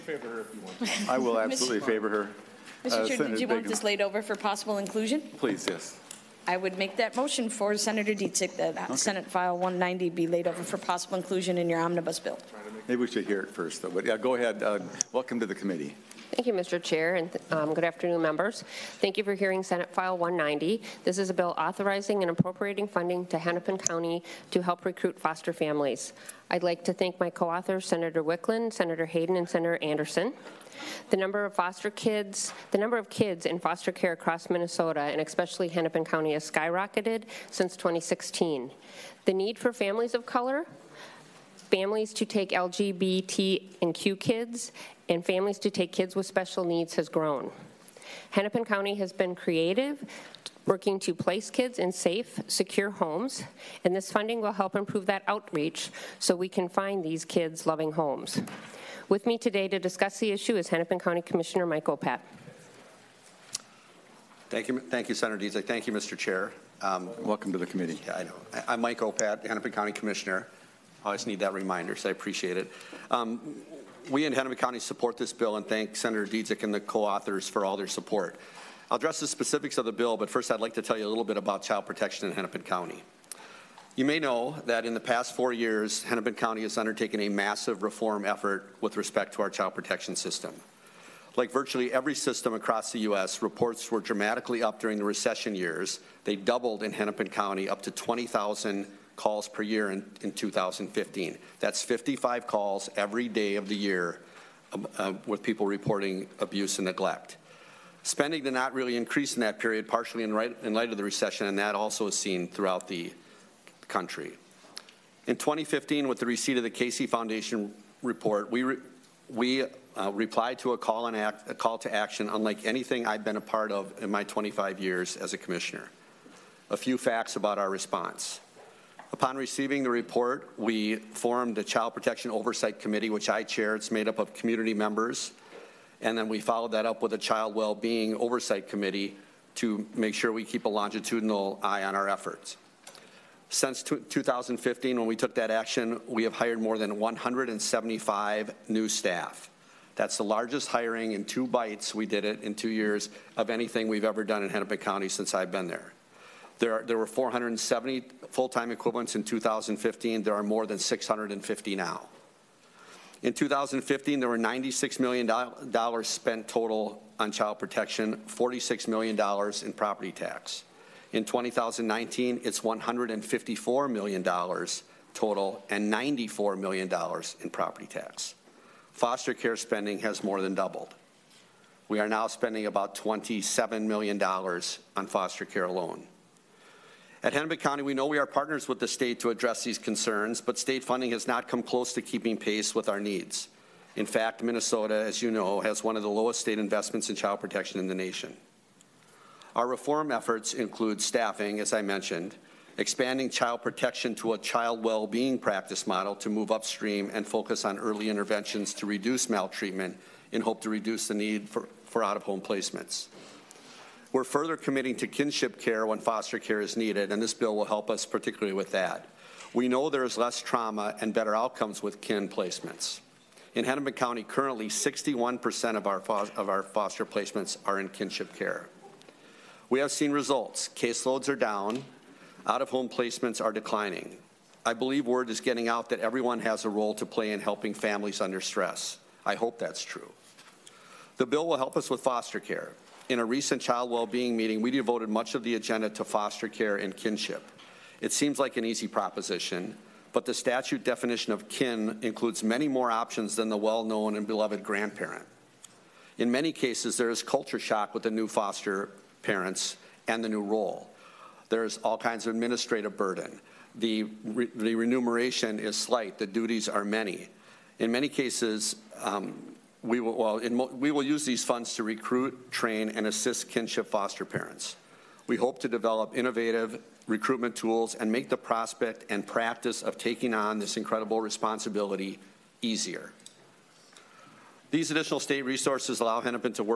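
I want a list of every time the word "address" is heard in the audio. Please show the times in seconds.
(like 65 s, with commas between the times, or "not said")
78 s, 189 s.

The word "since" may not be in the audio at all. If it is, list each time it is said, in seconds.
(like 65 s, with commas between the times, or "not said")
37 s, 143 s, 155 s.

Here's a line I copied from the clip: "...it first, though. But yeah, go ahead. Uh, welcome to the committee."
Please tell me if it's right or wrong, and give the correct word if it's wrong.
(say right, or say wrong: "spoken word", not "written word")
right.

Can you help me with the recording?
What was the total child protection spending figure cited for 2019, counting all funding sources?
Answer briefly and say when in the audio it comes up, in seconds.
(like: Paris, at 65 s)
$154 million, at 172 s.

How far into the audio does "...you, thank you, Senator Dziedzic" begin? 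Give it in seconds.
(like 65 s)
64 s.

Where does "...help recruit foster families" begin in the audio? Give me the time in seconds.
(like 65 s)
24 s.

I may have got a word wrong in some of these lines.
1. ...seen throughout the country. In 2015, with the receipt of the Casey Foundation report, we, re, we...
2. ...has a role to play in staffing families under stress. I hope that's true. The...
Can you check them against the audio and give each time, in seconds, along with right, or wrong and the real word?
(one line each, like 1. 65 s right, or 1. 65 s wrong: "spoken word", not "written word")
1. 112 s right
2. 236 s wrong: "helping", not "staffing".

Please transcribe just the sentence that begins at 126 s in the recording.
A few facts about our response.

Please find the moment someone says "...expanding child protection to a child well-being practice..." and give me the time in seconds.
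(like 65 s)
202 s.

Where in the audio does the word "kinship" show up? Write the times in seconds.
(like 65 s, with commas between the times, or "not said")
215 s, 227 s, 246 s, 273 s.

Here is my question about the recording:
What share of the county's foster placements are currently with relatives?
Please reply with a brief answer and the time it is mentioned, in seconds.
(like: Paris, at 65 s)
61%, at 224 s.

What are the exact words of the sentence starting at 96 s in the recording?
They doubled in Hennepin County up to 20,000 calls per year in, in 2015.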